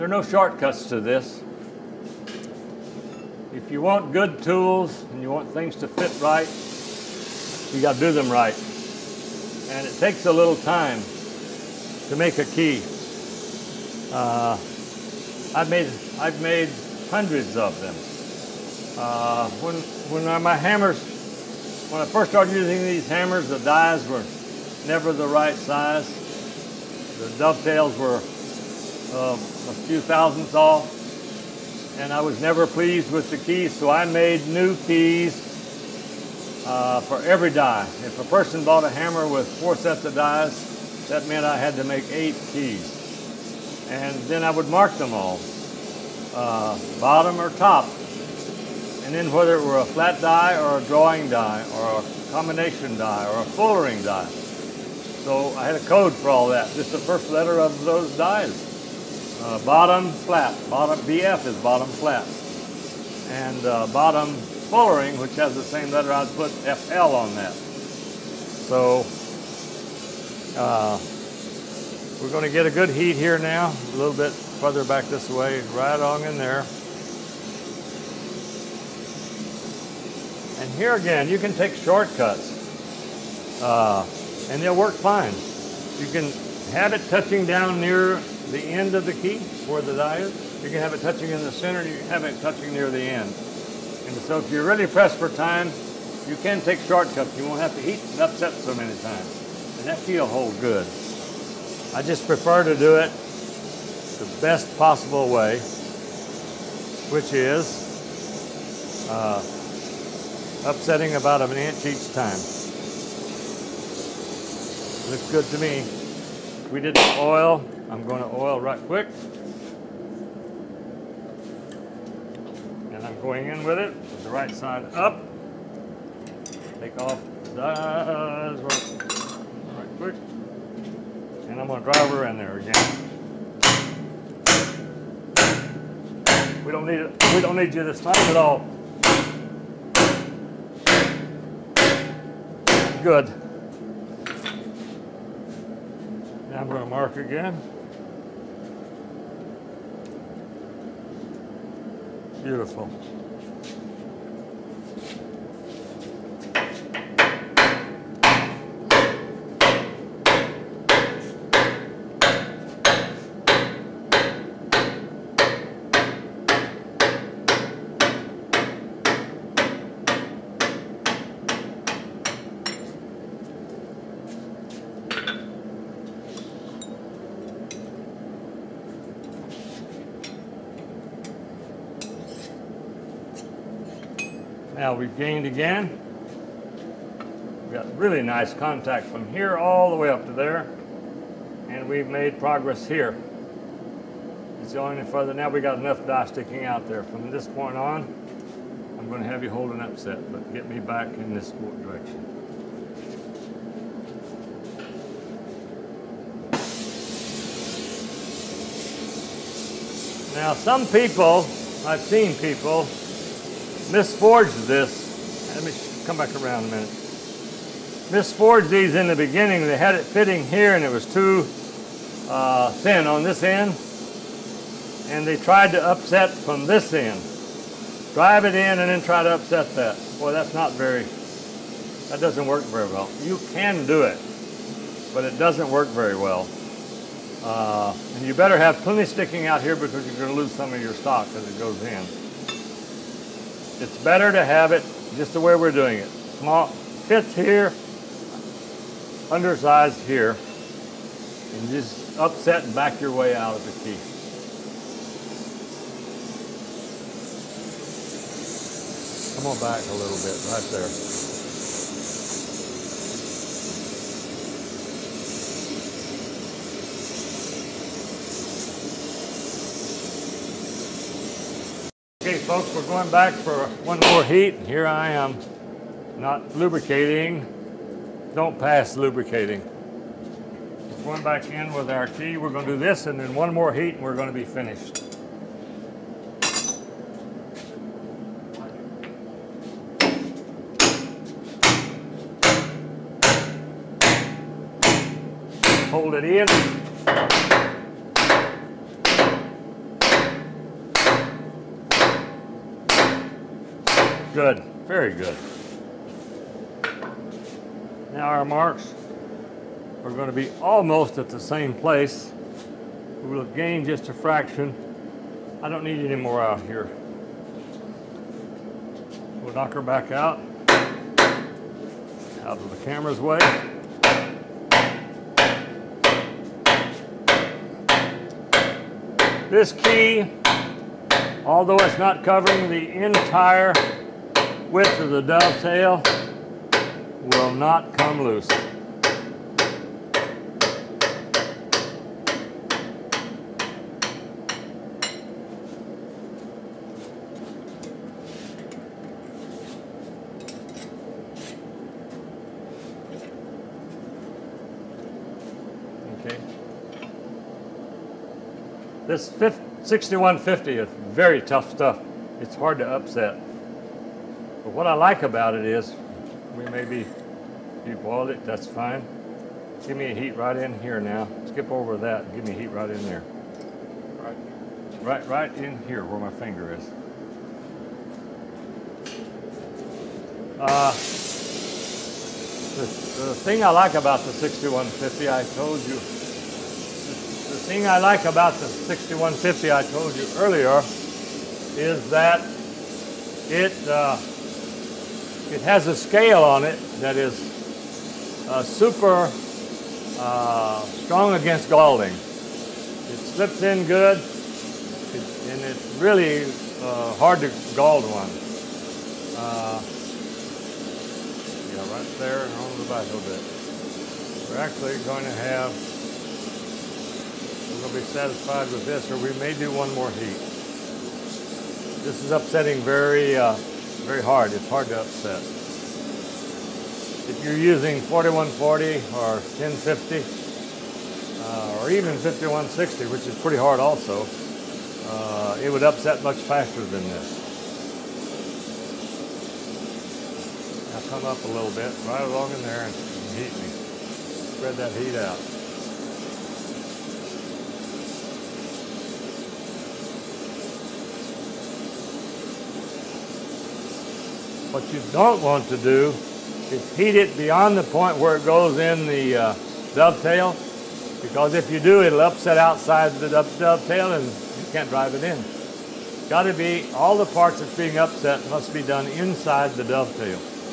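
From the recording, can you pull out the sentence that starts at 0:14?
Uh, I've made I've made hundreds of them.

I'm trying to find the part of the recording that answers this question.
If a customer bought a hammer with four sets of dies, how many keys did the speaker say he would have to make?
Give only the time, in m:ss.
0:42.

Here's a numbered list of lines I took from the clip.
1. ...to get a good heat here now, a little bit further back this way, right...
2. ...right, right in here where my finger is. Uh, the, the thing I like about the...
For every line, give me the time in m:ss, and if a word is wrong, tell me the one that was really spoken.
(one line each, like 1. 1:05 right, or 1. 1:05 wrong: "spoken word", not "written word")
1. 1:12 right
2. 6:15 right.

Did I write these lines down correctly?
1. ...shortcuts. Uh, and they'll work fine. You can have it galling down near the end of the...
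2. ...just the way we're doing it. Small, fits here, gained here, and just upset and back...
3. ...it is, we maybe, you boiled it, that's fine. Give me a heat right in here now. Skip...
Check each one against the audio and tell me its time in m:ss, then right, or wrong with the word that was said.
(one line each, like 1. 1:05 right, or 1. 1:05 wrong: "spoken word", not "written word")
1. 1:21 wrong: "touching", not "galling"
2. 4:05 wrong: "undersized", not "gained"
3. 6:05 right.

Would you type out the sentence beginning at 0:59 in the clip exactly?
Uh, bottom flat, bottom BF is bottom flat.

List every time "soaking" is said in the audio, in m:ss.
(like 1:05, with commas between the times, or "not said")
not said.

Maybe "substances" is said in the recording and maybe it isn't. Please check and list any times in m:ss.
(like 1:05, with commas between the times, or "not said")
not said.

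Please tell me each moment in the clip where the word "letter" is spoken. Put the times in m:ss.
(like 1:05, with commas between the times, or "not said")
0:57, 1:05.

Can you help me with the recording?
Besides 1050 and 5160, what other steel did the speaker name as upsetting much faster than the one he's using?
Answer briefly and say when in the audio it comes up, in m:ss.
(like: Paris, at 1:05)
4140, at 7:07.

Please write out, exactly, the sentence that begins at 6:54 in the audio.
We're actually going to have, we're going to be satisfied with this, or we may do one more heat.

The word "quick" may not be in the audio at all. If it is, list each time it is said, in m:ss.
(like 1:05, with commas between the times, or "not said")
1:58, 2:09.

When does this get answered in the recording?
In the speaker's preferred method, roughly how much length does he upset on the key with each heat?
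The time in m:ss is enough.
1:51.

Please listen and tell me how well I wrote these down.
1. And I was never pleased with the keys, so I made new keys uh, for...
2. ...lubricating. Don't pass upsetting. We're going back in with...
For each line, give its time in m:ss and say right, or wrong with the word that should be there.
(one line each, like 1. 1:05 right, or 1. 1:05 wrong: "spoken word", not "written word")
1. 0:31 right
2. 4:36 wrong: "lubricating", not "upsetting".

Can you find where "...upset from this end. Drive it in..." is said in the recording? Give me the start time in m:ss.
3:45.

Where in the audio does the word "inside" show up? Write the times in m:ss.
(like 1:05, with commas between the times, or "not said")
7:49.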